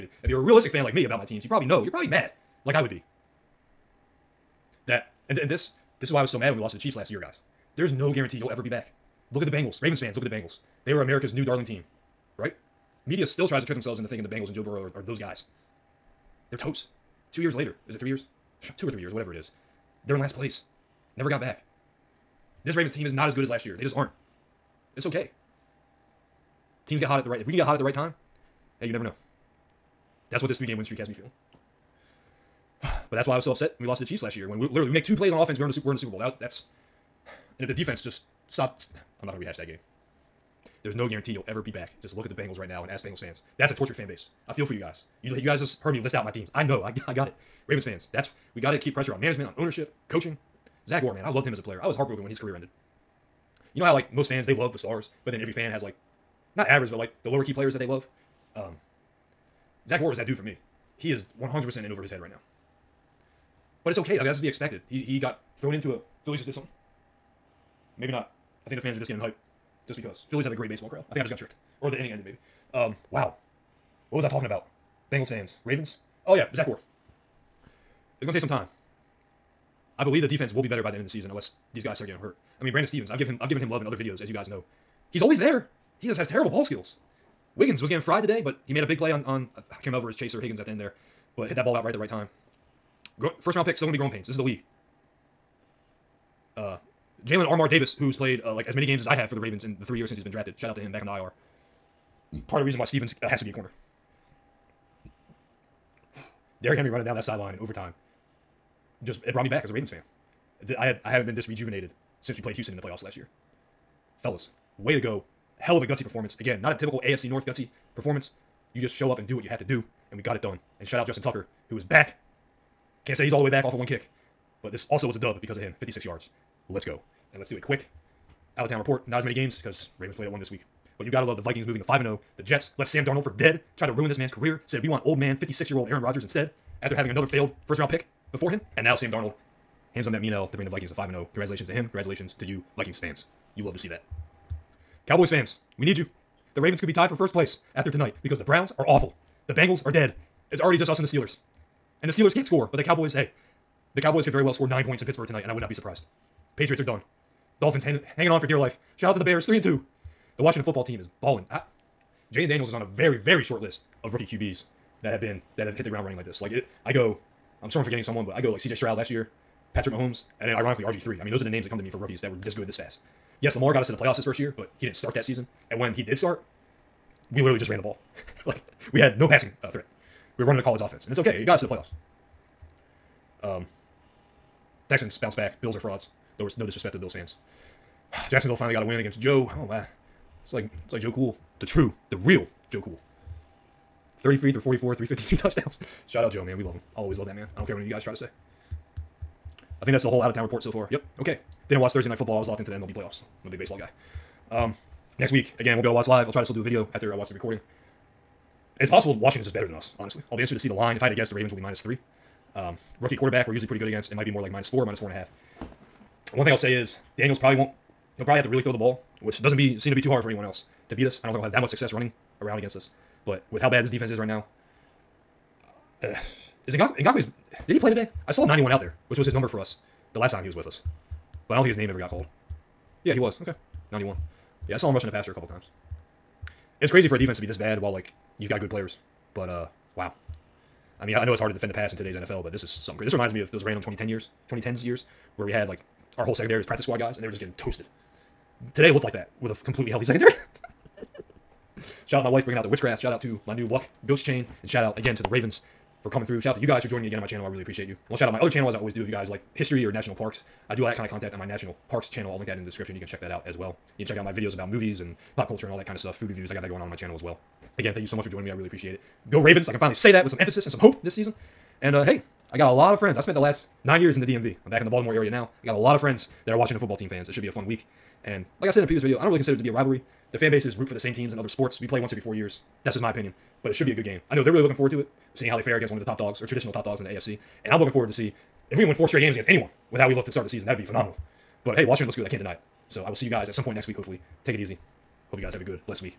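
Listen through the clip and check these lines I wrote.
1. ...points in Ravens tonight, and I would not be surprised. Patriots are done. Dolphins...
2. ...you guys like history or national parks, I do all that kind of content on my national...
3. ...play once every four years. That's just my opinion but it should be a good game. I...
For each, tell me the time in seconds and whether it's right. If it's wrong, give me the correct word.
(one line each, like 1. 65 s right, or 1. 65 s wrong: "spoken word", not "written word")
1. 154 s wrong: "Pittsburgh", not "Ravens"
2. 259 s right
3. 281 s right.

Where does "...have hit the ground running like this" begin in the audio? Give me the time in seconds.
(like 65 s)
165 s.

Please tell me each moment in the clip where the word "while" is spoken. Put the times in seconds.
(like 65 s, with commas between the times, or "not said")
237 s.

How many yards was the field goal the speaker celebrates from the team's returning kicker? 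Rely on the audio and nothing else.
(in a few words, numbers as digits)
56.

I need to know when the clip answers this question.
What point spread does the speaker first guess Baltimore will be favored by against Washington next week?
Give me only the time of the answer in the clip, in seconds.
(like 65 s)
211 s.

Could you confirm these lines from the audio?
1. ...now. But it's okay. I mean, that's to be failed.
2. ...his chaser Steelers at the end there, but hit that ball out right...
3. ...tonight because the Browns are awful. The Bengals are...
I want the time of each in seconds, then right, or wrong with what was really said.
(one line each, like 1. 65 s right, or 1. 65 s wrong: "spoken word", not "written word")
1. 62 s wrong: "expected", not "failed"
2. 90 s wrong: "Higgins", not "Steelers"
3. 147 s right.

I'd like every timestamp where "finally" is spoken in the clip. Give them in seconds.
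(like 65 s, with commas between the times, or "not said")
188 s, 269 s.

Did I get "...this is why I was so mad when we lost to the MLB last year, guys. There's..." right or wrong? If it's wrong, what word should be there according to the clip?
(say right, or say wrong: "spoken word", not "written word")
wrong: "Chiefs", not "MLB".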